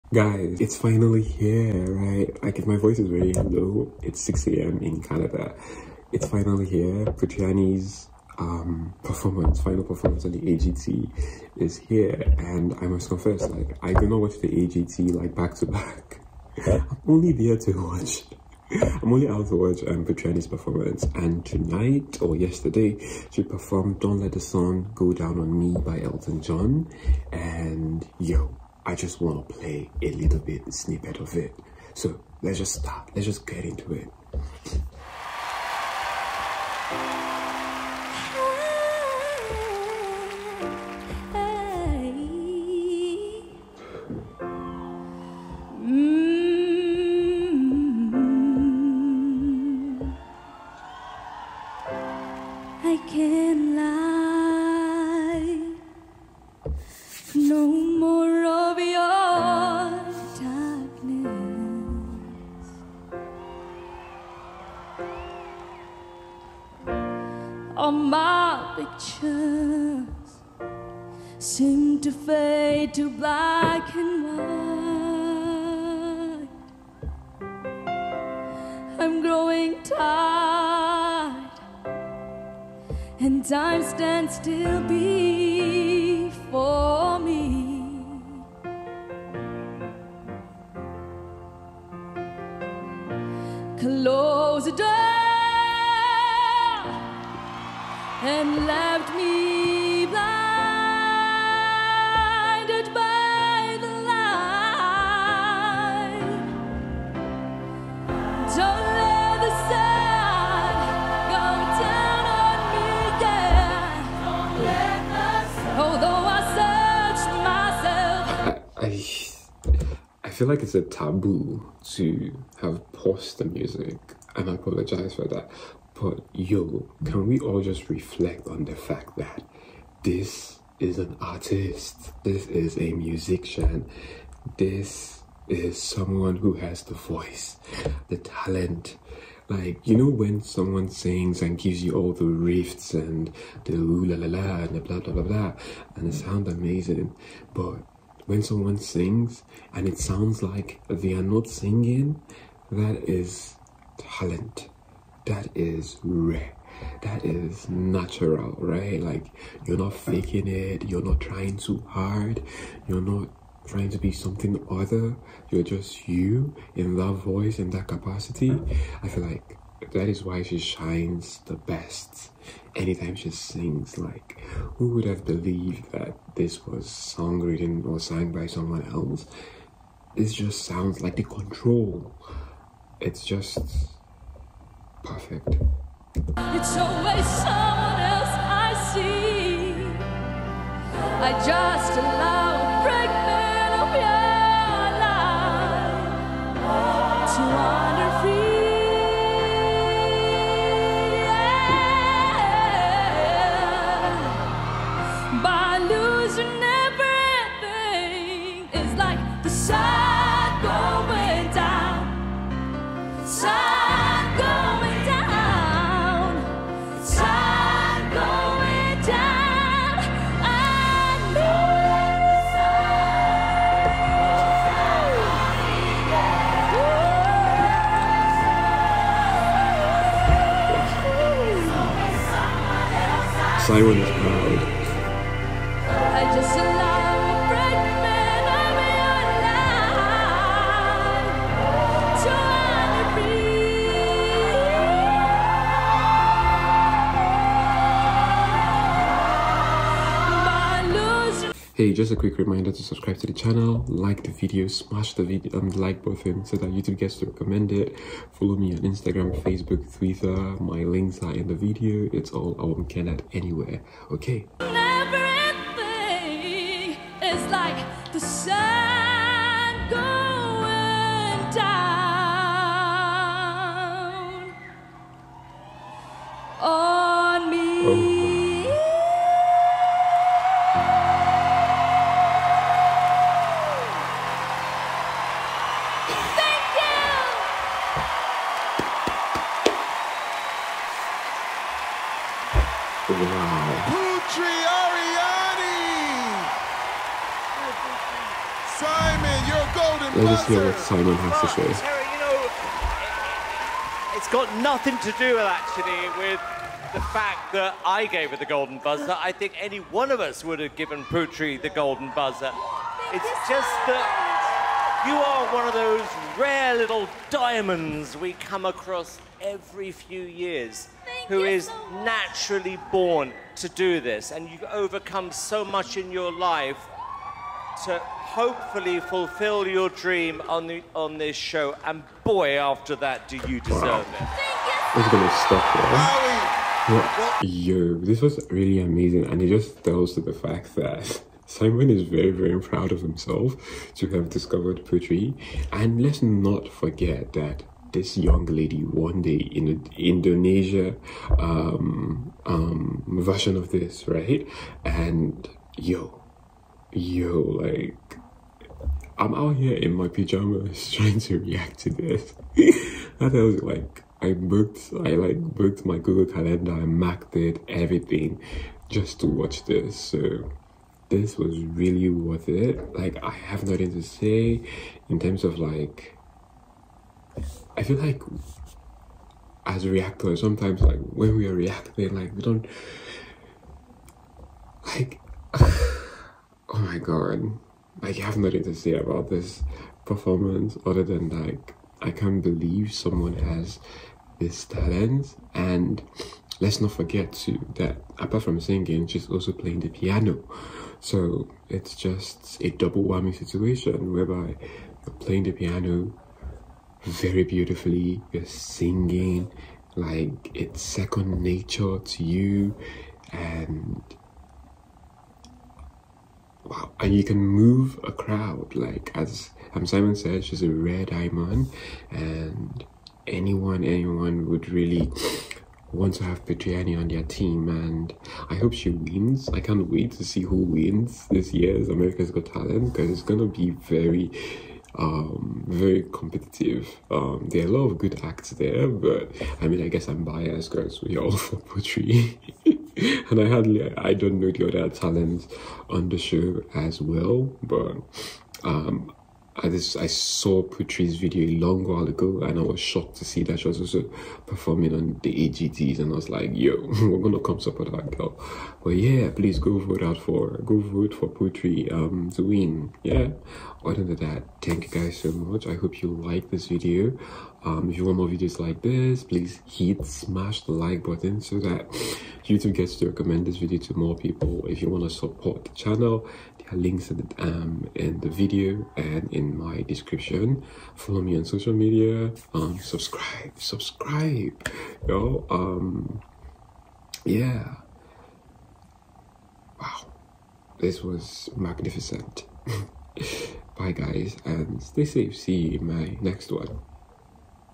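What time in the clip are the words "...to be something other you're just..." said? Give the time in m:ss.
2:43.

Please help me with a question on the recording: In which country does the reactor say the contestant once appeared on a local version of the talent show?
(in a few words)
Indonesia.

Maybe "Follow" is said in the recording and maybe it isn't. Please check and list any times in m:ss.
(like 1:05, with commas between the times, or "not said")
4:18, 8:00.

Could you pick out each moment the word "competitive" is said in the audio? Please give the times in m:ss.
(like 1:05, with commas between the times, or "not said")
7:16.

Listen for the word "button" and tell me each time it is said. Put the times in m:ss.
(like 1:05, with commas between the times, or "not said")
4:16, 7:51.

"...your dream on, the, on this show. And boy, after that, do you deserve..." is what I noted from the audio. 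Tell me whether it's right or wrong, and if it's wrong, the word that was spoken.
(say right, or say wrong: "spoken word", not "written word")
right.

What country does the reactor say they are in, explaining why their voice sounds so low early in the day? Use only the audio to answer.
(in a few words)
Canada.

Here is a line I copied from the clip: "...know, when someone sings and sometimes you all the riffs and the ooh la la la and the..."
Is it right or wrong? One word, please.
wrong.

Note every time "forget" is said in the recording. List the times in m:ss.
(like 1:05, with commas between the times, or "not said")
5:46, 6:36.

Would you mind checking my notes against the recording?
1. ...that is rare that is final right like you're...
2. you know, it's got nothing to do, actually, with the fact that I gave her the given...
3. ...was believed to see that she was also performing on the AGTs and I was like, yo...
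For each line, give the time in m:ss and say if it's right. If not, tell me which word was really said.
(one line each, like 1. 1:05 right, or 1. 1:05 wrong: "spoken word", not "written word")
1. 2:35 wrong: "natural", not "final"
2. 5:02 wrong: "golden", not "given"
3. 7:32 wrong: "shocked", not "believed".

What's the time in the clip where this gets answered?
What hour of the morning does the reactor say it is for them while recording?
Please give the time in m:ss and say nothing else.
0:04.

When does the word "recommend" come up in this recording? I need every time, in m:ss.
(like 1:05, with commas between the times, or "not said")
4:17, 7:53.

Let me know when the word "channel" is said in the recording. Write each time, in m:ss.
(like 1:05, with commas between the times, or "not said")
4:13, 7:55.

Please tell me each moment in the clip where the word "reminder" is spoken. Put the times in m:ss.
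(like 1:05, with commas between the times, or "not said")
4:12.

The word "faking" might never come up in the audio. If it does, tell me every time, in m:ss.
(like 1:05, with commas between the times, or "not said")
2:39.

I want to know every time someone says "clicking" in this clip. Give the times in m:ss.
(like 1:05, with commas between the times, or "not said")
not said.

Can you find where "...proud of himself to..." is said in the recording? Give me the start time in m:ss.
5:42.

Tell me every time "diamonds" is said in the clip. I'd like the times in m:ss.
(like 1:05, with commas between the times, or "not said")
5:17, 7:01.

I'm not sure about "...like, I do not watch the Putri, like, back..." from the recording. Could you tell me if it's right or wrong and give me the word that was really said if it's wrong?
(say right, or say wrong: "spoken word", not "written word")
wrong: "AGT", not "Putri".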